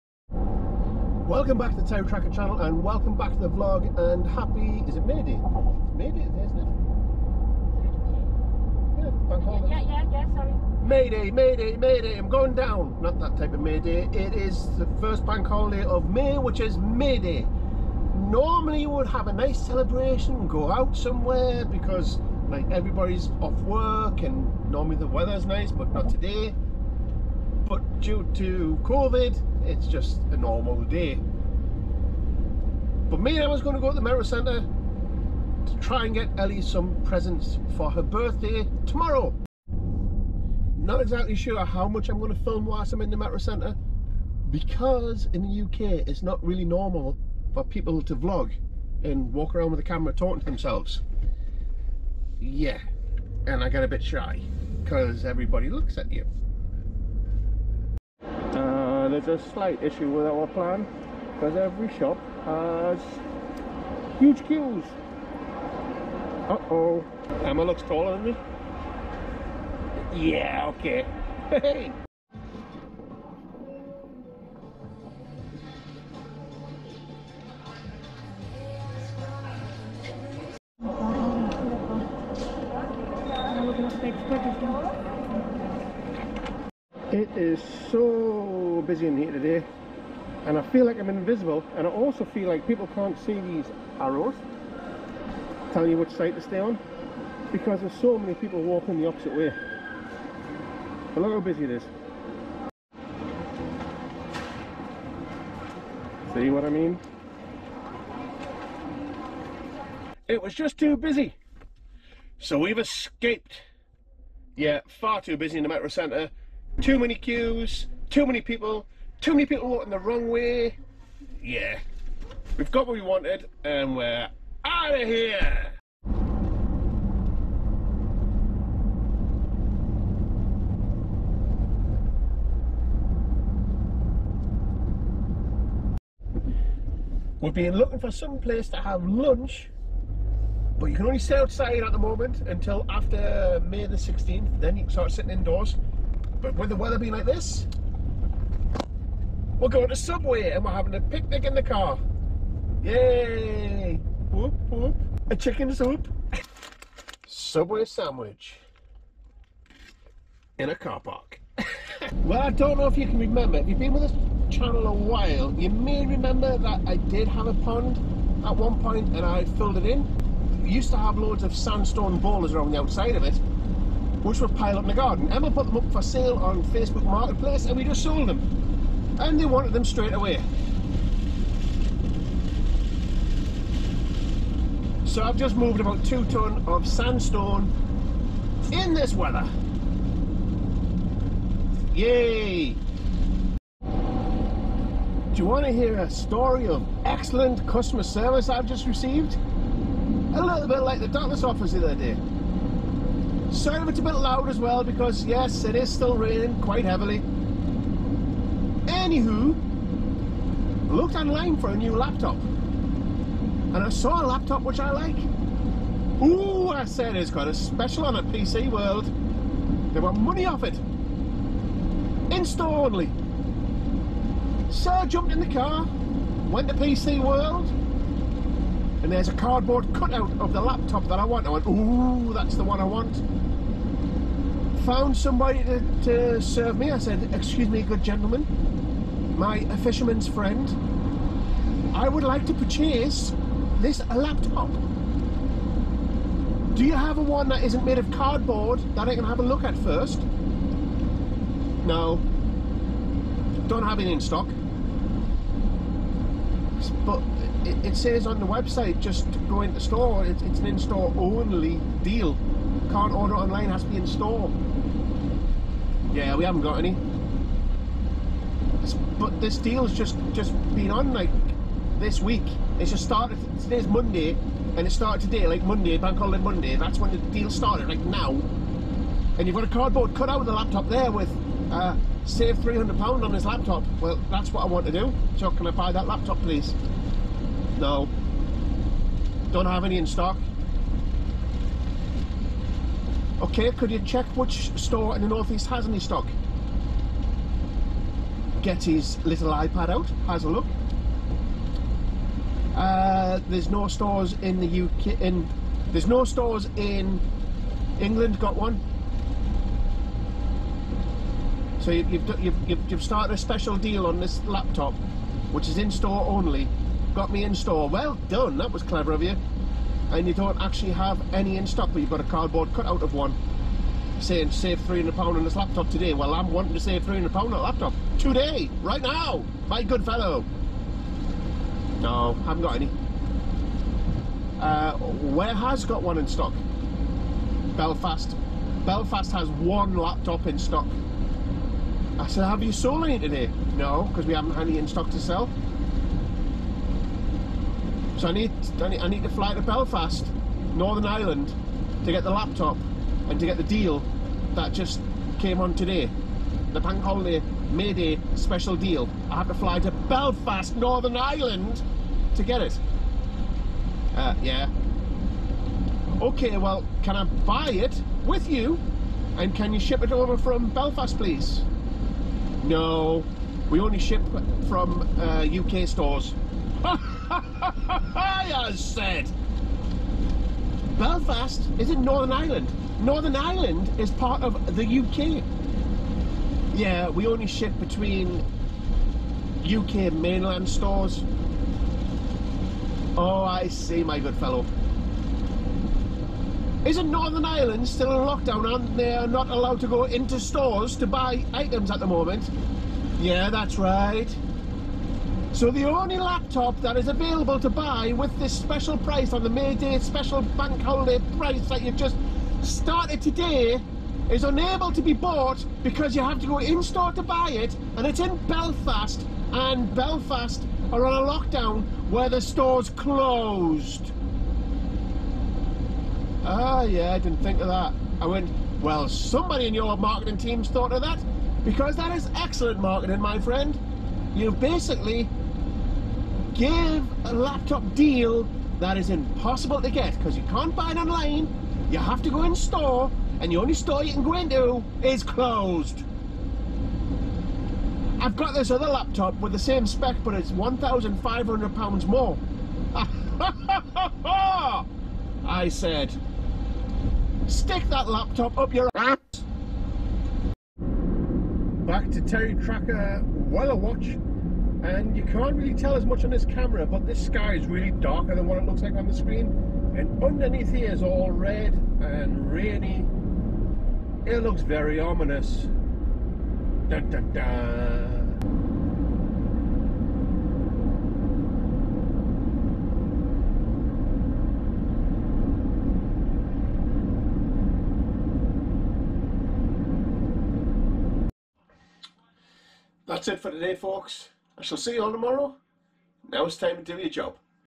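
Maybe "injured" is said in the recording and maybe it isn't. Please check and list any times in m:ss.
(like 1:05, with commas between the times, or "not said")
not said.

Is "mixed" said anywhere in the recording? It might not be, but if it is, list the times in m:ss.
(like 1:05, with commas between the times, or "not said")
not said.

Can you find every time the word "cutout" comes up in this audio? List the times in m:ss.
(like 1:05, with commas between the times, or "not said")
3:49, 5:22.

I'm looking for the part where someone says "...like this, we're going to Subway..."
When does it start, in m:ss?
2:27.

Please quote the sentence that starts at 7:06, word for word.
Ah yeah, I didn't think of that.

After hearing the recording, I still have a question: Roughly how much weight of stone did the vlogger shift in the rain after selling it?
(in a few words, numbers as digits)
2 ton.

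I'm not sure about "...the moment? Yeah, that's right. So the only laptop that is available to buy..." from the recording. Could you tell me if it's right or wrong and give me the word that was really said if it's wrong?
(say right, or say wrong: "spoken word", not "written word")
right.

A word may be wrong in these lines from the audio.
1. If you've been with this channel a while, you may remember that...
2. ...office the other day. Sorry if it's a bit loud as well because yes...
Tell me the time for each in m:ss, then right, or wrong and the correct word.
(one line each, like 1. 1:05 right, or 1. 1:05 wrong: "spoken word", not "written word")
1. 2:43 right
2. 3:21 right.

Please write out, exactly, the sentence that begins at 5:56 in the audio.
The bank holiday Mayday special deal.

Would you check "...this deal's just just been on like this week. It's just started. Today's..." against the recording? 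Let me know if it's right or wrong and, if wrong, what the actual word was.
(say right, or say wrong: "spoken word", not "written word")
right.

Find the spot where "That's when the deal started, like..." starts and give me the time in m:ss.
4:36.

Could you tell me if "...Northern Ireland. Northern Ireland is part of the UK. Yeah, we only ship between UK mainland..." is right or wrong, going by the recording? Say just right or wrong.
right.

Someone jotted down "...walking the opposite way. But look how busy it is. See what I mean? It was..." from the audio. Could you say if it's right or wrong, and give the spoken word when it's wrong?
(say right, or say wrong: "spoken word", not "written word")
right.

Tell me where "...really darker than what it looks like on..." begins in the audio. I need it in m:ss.
7:47.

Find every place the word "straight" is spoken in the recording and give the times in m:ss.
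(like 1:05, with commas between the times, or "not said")
2:59.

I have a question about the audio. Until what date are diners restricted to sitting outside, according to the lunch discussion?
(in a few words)
May 16th.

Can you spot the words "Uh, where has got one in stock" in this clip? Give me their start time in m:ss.
5:34.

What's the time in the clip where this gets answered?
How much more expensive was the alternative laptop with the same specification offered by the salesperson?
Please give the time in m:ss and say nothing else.
7:30.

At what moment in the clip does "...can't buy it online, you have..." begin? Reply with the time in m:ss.
7:20.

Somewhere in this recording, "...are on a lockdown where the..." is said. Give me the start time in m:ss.
7:00.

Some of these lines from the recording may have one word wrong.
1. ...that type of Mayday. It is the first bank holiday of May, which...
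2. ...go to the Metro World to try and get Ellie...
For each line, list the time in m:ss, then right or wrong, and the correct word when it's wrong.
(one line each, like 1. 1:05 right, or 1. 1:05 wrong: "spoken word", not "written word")
1. 0:13 right
2. 0:33 wrong: "Centre", not "World".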